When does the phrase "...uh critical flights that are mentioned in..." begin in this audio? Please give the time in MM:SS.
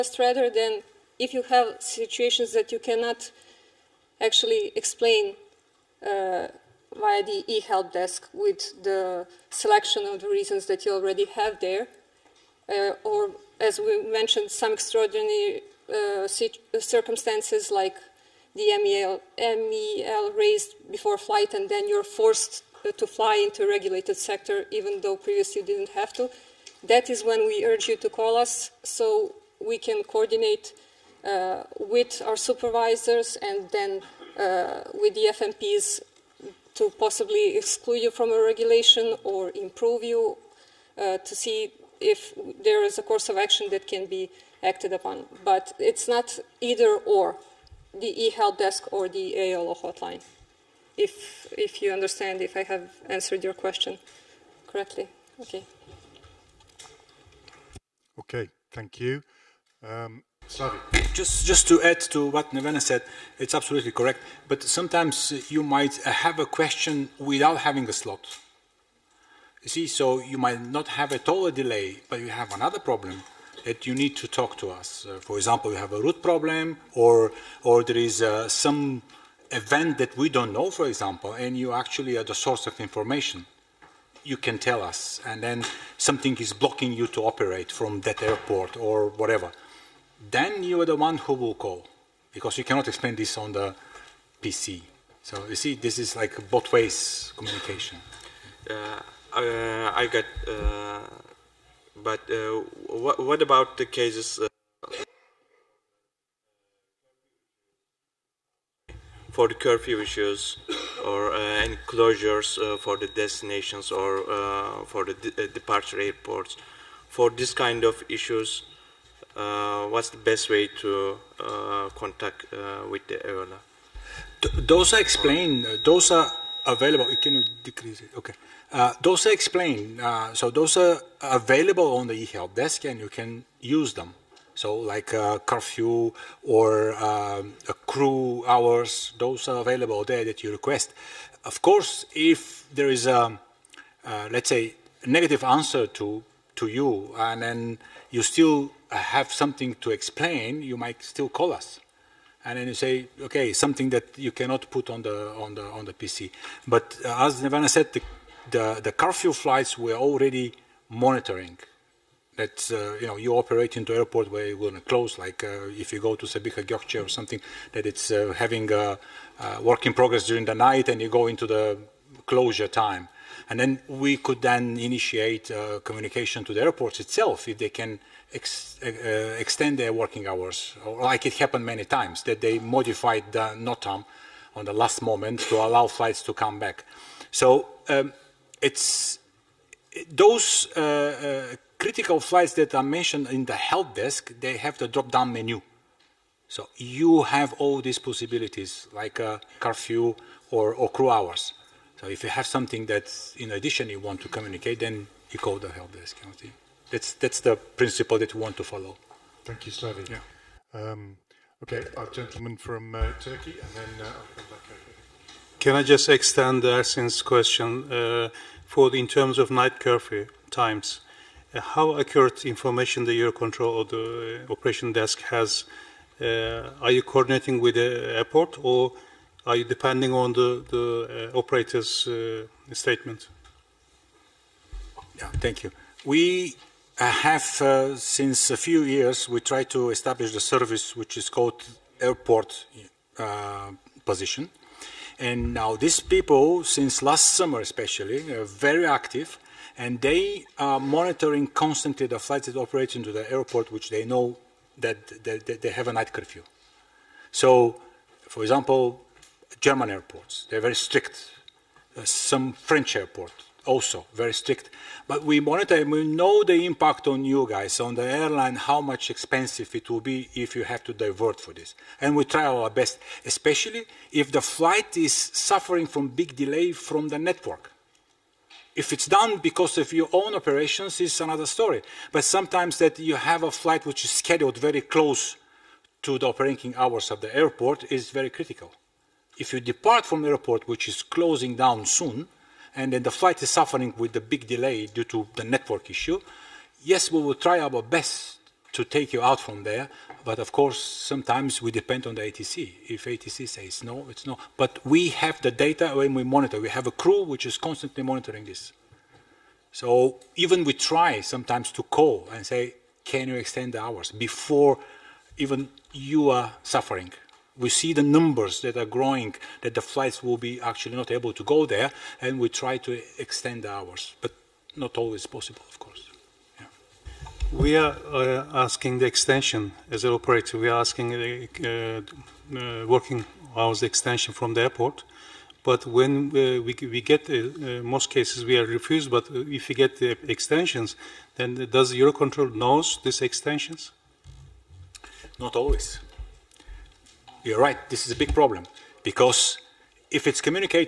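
03:10.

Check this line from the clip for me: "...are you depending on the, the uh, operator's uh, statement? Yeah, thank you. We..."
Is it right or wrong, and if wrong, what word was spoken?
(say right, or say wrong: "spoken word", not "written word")
right.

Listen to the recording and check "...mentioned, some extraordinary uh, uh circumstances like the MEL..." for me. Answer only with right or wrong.
right.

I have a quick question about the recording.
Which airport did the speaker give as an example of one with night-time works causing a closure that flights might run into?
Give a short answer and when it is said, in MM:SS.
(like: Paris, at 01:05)
Sabiha Gökçe, at 02:46.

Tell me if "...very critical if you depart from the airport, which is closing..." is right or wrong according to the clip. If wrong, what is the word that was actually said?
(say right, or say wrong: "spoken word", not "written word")
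right.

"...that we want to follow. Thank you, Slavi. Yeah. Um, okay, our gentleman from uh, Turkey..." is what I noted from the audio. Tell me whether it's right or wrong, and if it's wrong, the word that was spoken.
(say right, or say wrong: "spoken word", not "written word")
right.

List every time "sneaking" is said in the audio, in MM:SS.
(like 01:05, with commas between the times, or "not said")
not said.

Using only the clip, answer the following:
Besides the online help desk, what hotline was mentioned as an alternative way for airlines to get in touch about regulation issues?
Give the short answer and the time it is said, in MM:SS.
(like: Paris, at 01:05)
AOLO hotline, at 00:49.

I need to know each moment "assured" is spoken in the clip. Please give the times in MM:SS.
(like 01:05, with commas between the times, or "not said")
not said.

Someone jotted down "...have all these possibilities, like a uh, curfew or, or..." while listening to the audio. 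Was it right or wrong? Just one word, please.
right.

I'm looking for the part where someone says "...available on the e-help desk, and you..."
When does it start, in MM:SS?
02:11.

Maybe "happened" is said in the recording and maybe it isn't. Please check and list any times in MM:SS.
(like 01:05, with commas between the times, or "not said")
03:01.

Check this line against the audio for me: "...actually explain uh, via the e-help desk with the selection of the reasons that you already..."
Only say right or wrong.
right.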